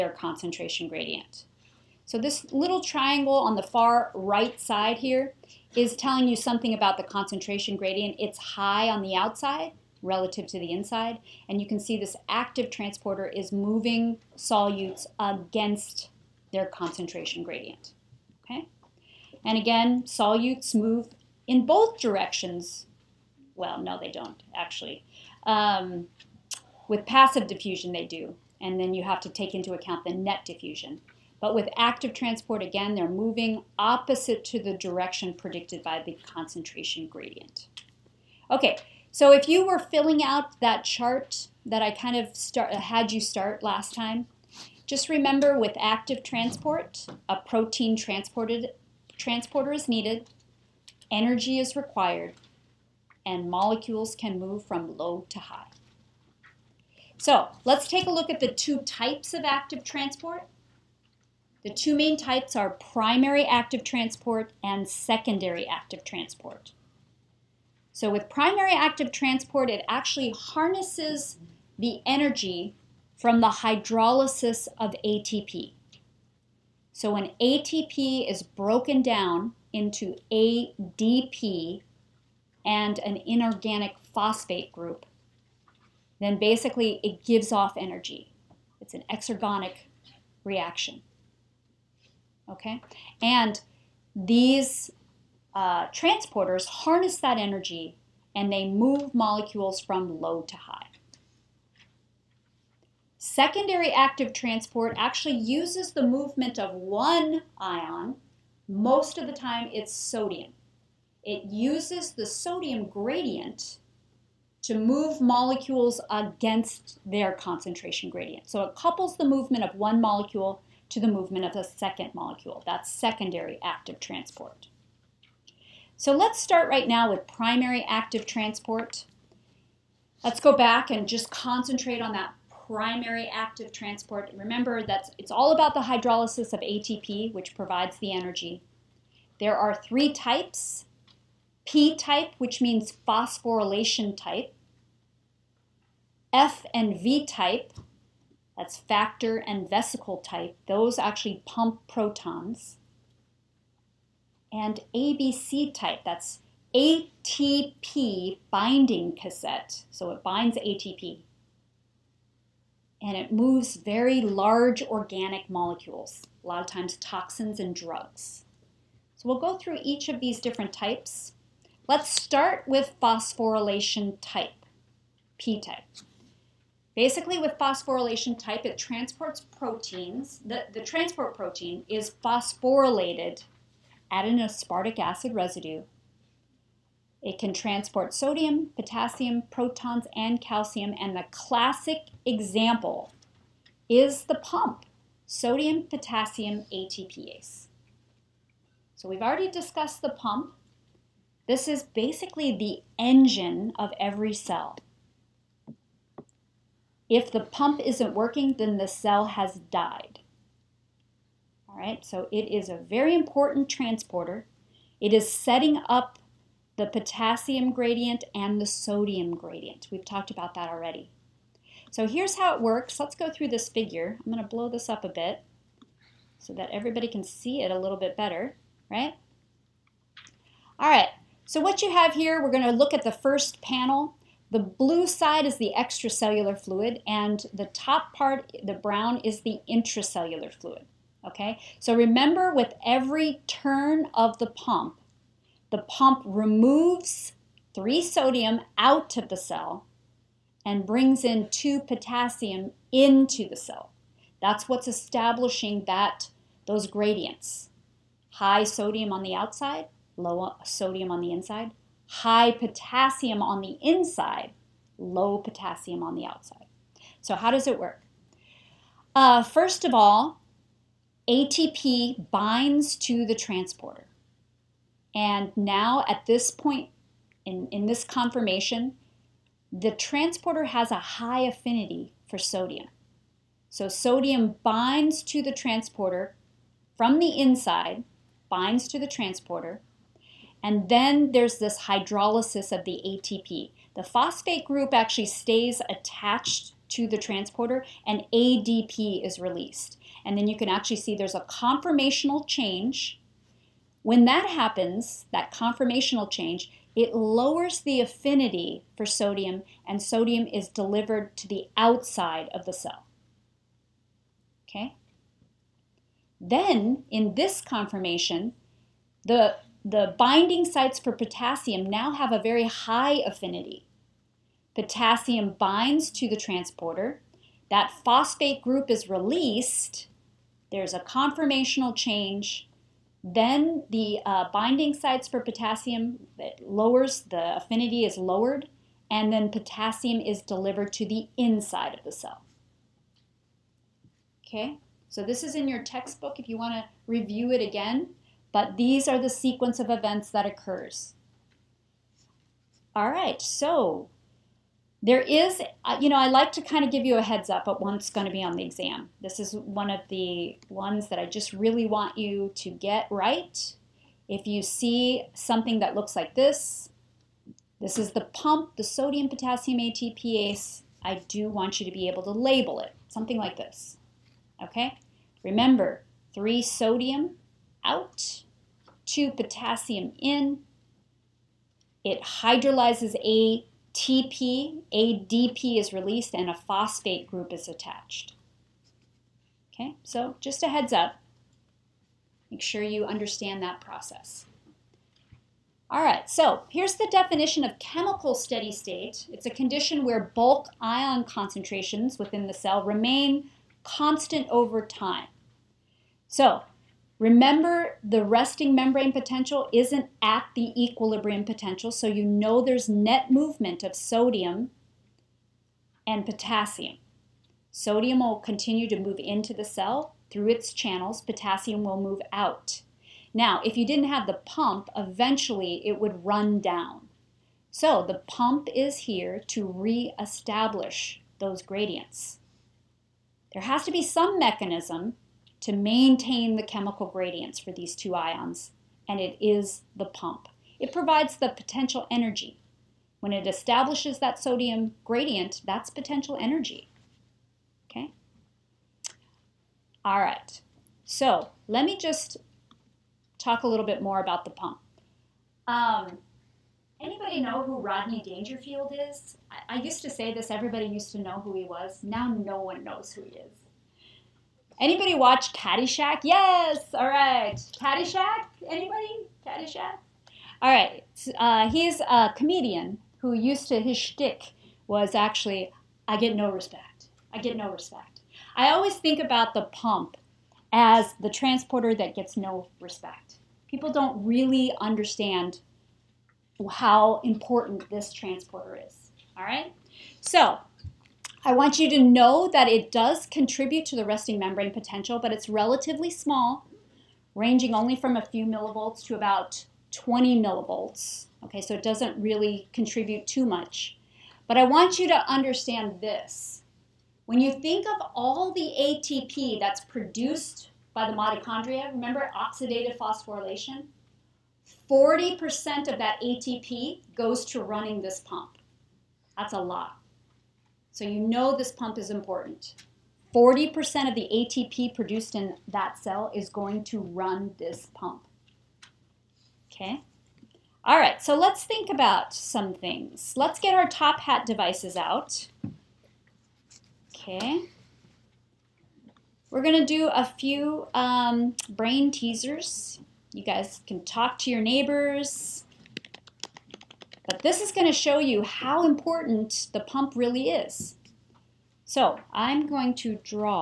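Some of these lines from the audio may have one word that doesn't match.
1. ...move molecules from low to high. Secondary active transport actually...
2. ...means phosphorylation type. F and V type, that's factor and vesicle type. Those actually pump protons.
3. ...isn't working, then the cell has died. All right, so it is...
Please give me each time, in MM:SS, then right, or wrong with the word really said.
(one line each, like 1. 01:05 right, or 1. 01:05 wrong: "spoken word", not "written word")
1. 01:38 right
2. 02:22 right
3. 03:27 right.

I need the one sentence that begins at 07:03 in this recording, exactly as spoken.
Now, if you didn't have the pump, eventually it would run down.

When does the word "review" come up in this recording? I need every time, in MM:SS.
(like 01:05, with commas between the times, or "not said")
05:47.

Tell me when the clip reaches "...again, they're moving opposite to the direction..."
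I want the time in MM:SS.
00:32.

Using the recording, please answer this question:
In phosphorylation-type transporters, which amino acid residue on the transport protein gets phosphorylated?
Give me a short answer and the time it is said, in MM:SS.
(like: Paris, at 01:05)
Aspartic acid, at 03:04.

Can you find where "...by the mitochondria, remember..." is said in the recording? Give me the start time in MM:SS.
08:30.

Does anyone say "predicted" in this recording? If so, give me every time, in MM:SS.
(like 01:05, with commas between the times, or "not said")
00:35.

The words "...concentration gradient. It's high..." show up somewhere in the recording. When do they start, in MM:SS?
00:07.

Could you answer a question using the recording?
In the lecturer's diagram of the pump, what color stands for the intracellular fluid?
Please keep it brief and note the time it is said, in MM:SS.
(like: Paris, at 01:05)
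Brown, at 03:58.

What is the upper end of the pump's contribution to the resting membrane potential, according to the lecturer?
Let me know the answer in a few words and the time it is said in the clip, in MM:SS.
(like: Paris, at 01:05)
About 20 millivolts, at 08:19.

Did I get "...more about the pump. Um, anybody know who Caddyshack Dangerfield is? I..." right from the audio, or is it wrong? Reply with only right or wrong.
wrong.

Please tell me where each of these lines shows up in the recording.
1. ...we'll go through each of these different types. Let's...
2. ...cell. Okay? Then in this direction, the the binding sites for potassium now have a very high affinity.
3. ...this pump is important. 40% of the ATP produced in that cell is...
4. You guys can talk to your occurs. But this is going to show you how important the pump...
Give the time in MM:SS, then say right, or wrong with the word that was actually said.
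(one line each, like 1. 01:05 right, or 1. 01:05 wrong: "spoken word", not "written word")
1. 02:49 right
2. 05:12 wrong: "conformation", not "direction"
3. 08:41 right
4. 09:03 wrong: "neighbors", not "occurs".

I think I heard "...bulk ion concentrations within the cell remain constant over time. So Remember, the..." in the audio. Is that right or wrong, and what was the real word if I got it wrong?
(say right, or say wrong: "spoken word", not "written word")
right.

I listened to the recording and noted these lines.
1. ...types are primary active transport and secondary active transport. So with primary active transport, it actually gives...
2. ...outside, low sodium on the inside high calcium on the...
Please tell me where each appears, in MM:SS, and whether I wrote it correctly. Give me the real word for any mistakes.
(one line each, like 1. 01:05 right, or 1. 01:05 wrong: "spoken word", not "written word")
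1. 01:02 wrong: "harnesses", not "gives"
2. 04:19 wrong: "potassium", not "calcium".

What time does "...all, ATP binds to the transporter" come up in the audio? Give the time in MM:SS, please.
04:29.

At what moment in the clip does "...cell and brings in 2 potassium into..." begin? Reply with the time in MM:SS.
04:09.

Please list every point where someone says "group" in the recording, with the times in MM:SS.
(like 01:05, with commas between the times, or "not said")
01:24, 04:54, 05:28, 06:27.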